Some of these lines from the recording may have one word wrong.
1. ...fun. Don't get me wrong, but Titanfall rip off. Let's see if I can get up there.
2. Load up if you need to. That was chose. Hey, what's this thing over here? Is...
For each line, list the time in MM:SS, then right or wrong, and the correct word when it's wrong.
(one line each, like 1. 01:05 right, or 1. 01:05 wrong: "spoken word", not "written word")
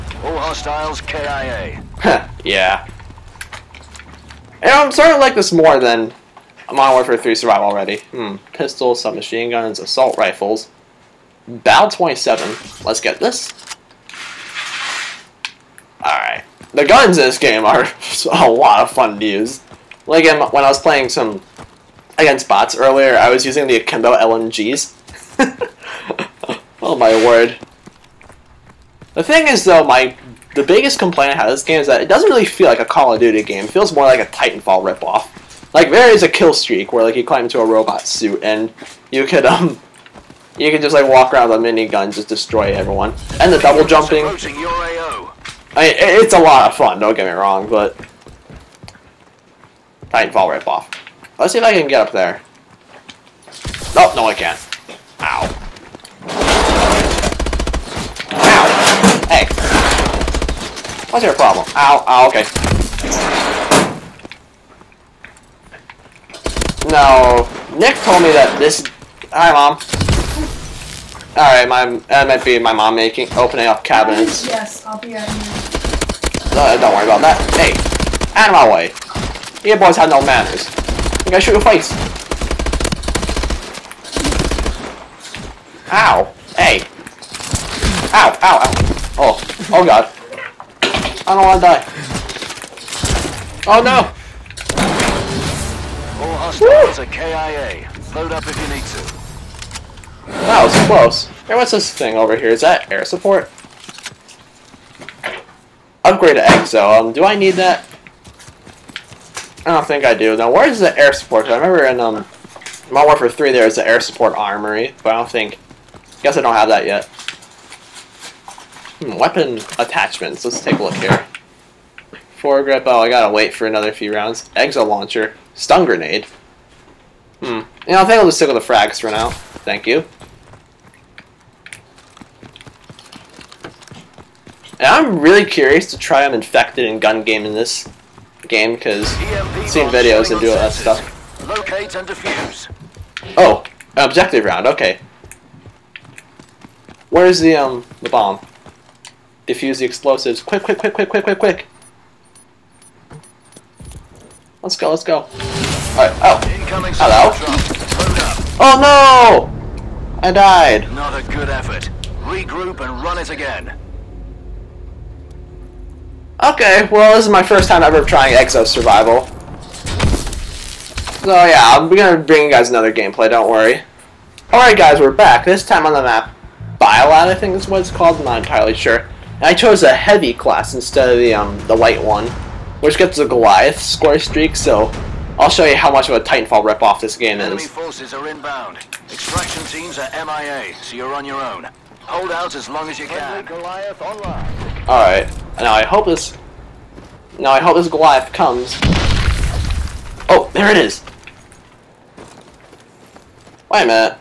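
1. 00:46 right
2. 01:38 wrong: "close", not "chose".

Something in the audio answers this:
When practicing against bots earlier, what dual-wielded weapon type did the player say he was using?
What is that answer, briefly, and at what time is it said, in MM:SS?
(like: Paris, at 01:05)
Akimbo LMGs, at 00:23.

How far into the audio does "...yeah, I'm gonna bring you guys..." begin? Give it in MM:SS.
02:51.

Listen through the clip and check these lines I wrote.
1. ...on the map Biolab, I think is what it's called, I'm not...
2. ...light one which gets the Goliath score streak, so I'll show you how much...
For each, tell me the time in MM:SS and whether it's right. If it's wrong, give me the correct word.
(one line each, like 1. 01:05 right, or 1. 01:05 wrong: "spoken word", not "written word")
1. 02:55 right
2. 03:01 right.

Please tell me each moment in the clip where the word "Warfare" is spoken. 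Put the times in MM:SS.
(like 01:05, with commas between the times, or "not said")
00:06, 01:53.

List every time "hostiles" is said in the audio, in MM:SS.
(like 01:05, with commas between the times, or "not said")
00:00, 01:36.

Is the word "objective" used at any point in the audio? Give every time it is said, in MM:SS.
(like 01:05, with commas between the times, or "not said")
02:23.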